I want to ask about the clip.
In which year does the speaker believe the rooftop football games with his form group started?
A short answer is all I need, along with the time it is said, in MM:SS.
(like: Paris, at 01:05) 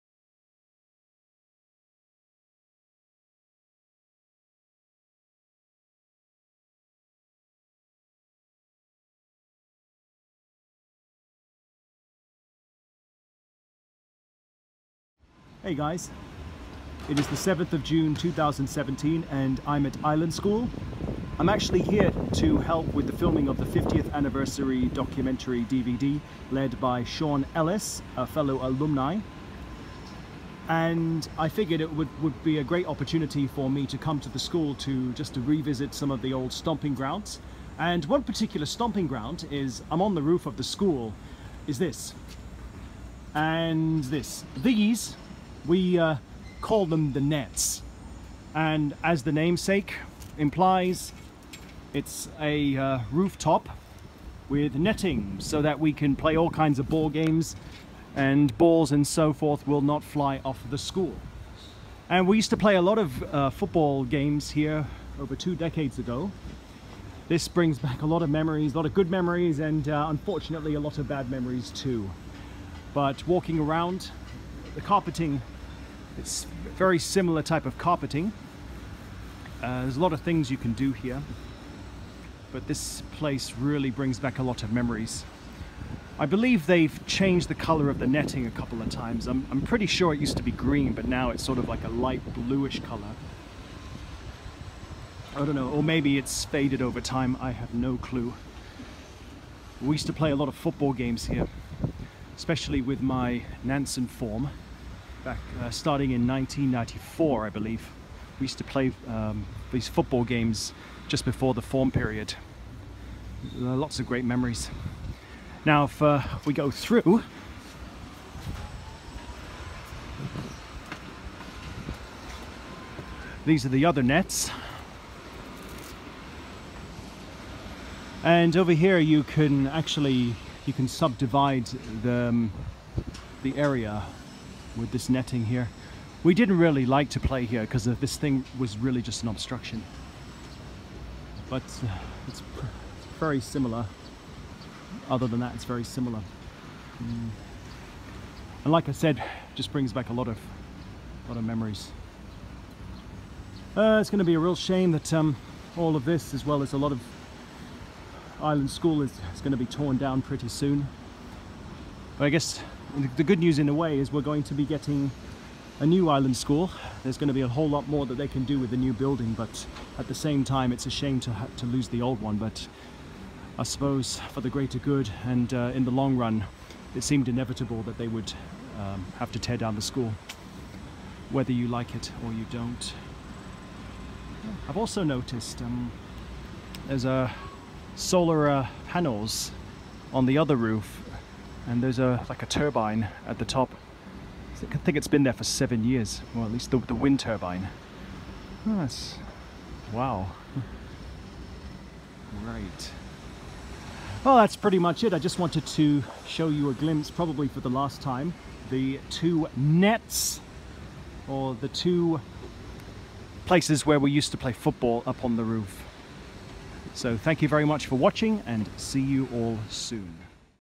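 1994, at 01:46.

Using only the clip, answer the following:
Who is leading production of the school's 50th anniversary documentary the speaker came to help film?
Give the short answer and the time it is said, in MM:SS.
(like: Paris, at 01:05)
Sean Ellis, at 00:27.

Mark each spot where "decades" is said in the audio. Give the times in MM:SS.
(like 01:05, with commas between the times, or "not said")
01:05.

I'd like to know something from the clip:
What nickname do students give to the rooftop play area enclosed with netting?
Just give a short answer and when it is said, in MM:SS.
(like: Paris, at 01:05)
the nets, at 00:47.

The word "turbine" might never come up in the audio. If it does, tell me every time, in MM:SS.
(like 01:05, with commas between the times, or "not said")
03:12, 03:17.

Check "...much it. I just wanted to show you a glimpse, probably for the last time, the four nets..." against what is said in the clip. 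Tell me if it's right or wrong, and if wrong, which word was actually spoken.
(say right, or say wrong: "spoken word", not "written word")
wrong: "two", not "four".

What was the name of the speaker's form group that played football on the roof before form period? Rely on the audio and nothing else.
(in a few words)
Nansen.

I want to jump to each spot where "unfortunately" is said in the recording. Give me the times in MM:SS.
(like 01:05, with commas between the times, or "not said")
01:10.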